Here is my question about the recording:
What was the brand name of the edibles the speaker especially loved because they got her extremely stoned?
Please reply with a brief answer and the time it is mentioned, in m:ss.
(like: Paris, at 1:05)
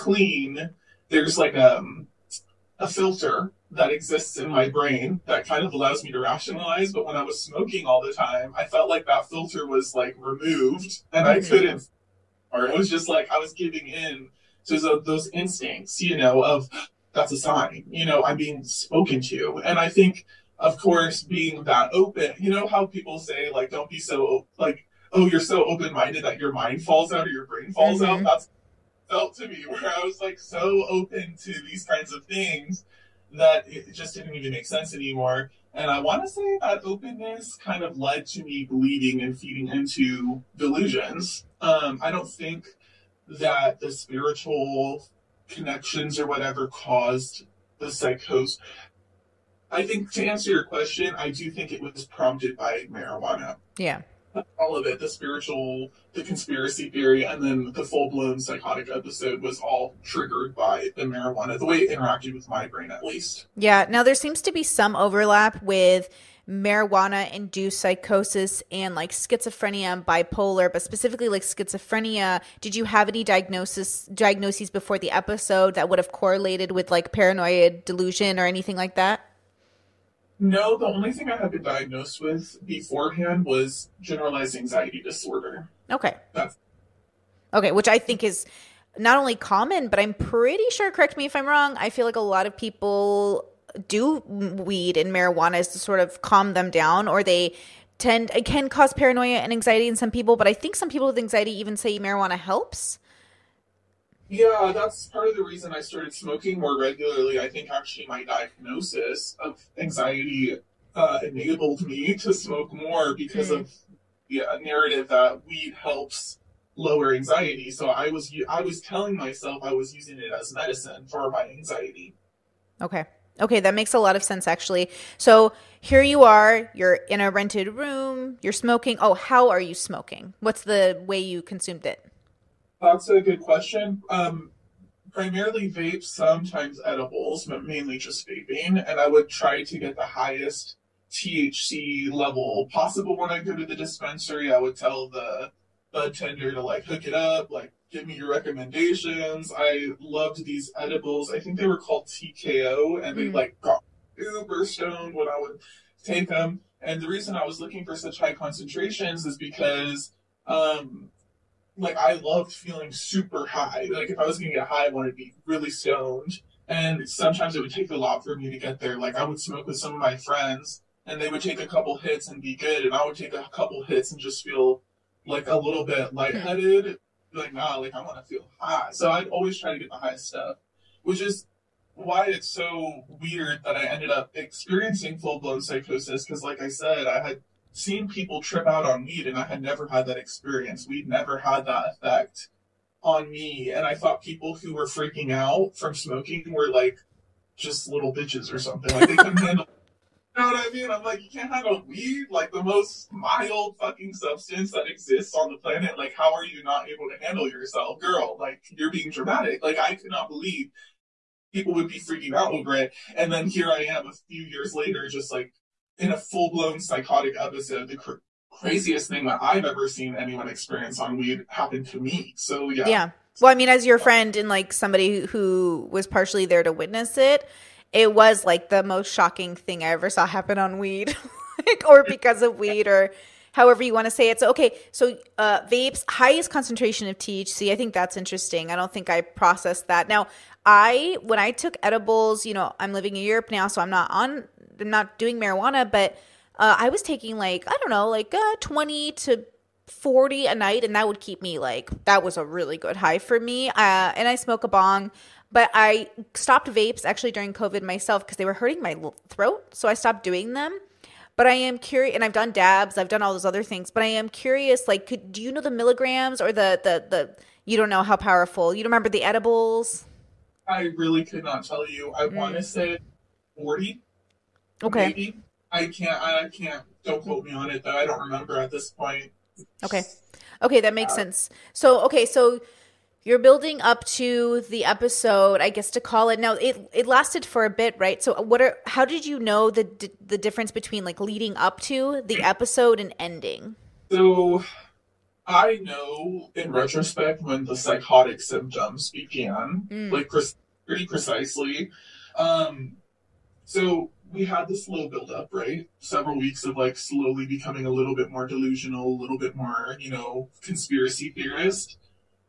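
TKO, at 2:32.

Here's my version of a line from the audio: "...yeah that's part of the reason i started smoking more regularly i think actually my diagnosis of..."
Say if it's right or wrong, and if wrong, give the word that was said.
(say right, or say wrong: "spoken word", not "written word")
right.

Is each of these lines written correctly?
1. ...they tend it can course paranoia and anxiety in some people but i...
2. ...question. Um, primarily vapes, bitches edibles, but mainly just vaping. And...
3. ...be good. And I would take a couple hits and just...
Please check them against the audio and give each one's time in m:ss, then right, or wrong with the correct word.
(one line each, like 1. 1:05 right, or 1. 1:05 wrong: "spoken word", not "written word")
1. 1:37 wrong: "cause", not "course"
2. 2:13 wrong: "sometimes", not "bitches"
3. 2:52 right.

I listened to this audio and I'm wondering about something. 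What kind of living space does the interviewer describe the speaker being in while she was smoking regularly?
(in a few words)
rented room.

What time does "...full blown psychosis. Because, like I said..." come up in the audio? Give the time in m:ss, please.
3:05.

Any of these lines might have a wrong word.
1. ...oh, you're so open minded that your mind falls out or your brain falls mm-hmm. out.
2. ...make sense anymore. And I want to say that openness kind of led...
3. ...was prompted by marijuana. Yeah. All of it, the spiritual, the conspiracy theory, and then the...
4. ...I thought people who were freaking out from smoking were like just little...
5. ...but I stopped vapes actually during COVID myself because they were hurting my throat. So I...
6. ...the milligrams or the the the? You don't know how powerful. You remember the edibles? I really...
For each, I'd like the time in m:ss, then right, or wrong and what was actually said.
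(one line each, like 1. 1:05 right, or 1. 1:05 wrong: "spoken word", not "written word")
1. 0:25 right
2. 0:34 right
3. 0:51 right
4. 3:13 right
5. 4:15 right
6. 4:25 right.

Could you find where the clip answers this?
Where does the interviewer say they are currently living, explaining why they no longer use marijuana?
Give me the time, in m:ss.
4:03.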